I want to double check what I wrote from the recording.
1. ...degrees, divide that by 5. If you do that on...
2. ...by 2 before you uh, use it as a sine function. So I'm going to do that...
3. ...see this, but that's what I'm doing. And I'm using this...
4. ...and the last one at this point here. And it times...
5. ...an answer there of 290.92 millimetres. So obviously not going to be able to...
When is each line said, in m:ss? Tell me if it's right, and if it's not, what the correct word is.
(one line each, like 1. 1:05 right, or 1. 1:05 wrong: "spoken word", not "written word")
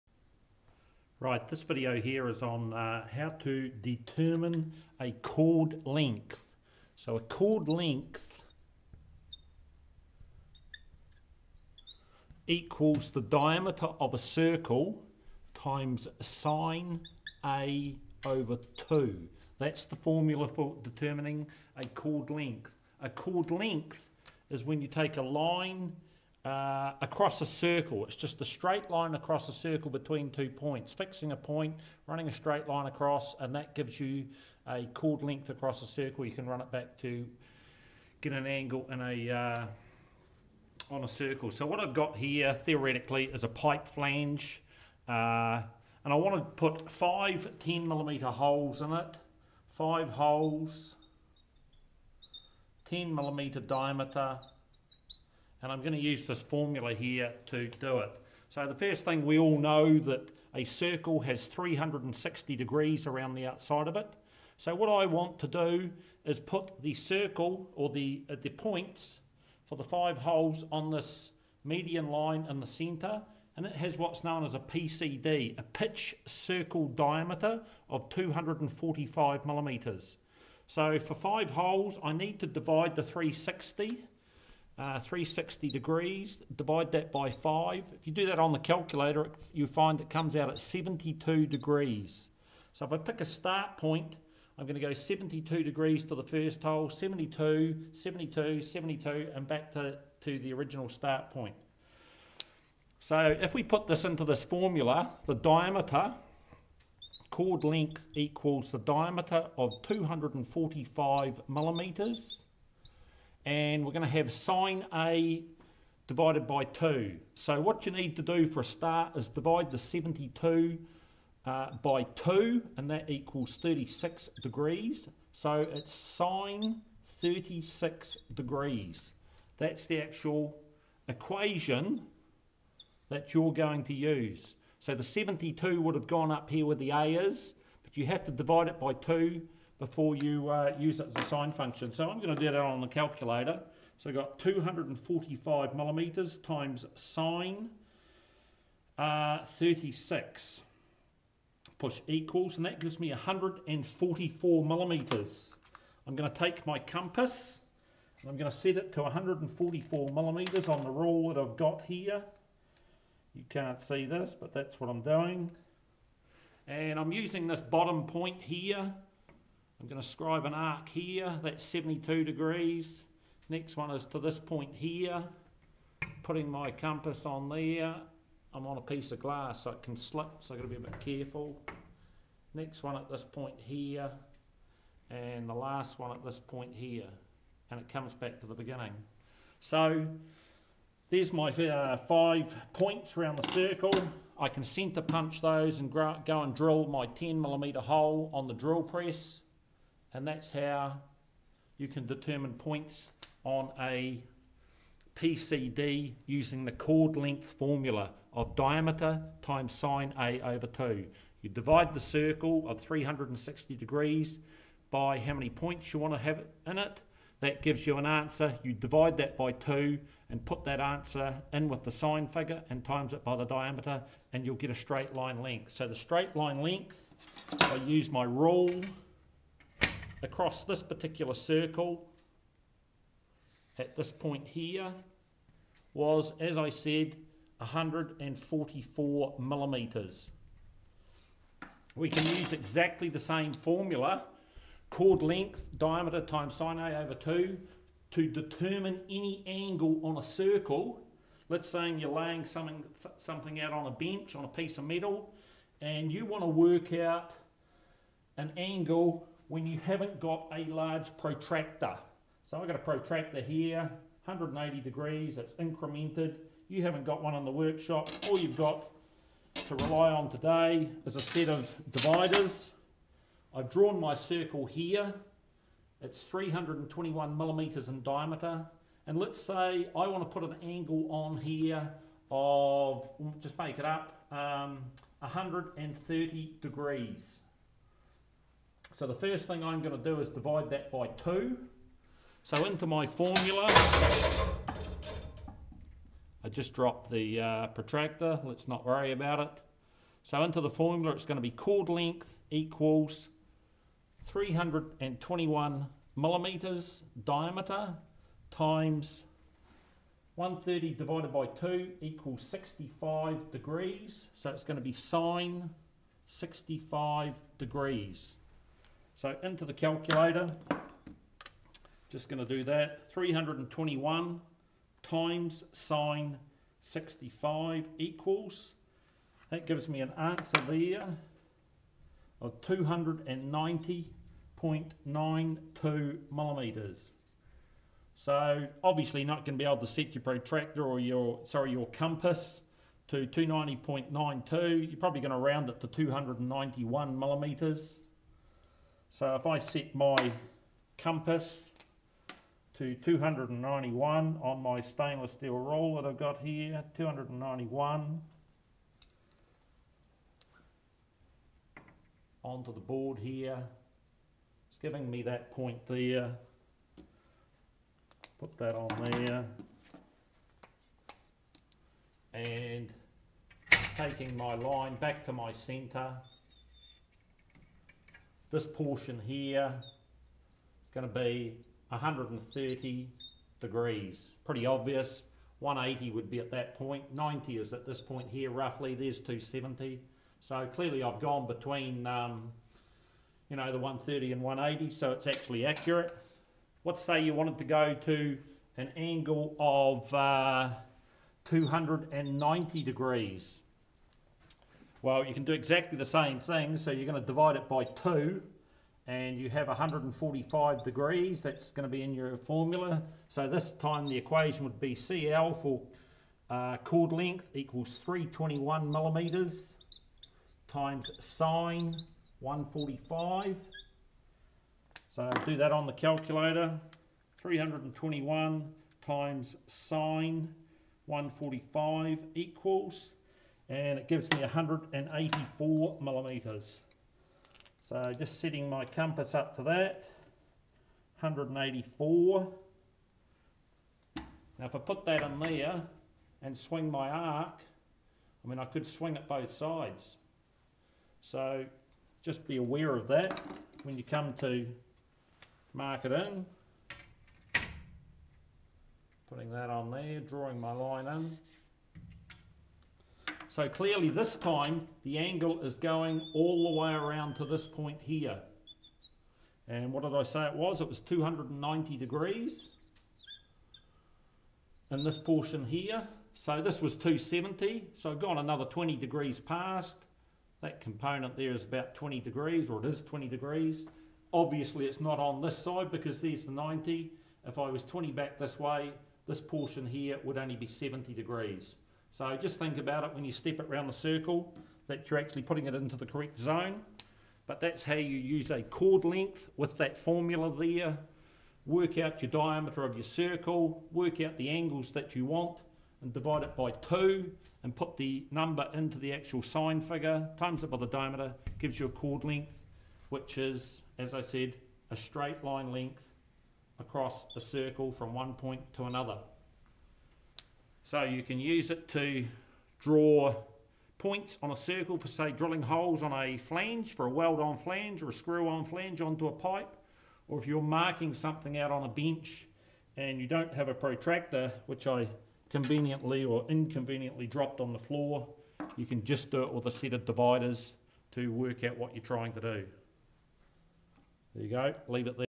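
1. 1:25 right
2. 2:18 right
3. 2:43 right
4. 3:05 wrong: "comes", not "times"
5. 5:30 right.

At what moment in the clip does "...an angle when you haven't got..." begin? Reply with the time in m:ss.
4:18.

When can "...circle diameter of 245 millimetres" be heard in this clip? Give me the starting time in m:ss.
1:16.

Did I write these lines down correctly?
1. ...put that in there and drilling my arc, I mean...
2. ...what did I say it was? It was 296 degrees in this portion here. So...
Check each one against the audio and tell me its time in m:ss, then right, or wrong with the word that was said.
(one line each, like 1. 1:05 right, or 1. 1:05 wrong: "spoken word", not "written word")
1. 7:24 wrong: "swing", not "drilling"
2. 7:49 wrong: "290", not "296".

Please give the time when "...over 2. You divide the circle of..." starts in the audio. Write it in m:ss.
3:30.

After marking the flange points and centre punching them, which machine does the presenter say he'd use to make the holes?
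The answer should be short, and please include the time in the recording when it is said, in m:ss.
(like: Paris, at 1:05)
drill press, at 3:18.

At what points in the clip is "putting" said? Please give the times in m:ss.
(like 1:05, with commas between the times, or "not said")
2:56, 7:39, 8:15.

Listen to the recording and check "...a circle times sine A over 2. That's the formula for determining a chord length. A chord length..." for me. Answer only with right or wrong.
right.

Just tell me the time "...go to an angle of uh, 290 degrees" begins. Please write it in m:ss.
6:37.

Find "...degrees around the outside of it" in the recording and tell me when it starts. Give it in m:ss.
1:02.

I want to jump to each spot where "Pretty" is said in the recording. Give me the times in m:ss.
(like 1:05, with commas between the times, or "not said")
6:24.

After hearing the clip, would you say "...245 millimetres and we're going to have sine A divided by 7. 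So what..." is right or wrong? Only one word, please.
wrong.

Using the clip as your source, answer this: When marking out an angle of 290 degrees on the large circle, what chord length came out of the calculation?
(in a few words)
184 millimetres.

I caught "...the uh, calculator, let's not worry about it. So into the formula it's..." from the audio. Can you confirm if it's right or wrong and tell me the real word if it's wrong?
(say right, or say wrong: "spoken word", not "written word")
wrong: "protractor", not "calculator".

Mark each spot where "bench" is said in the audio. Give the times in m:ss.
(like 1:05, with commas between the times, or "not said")
4:13, 8:51.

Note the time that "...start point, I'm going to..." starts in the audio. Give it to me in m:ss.
1:33.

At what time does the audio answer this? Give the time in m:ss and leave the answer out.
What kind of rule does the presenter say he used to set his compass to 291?
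5:54.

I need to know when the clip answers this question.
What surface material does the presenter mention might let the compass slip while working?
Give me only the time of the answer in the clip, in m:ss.
2:59.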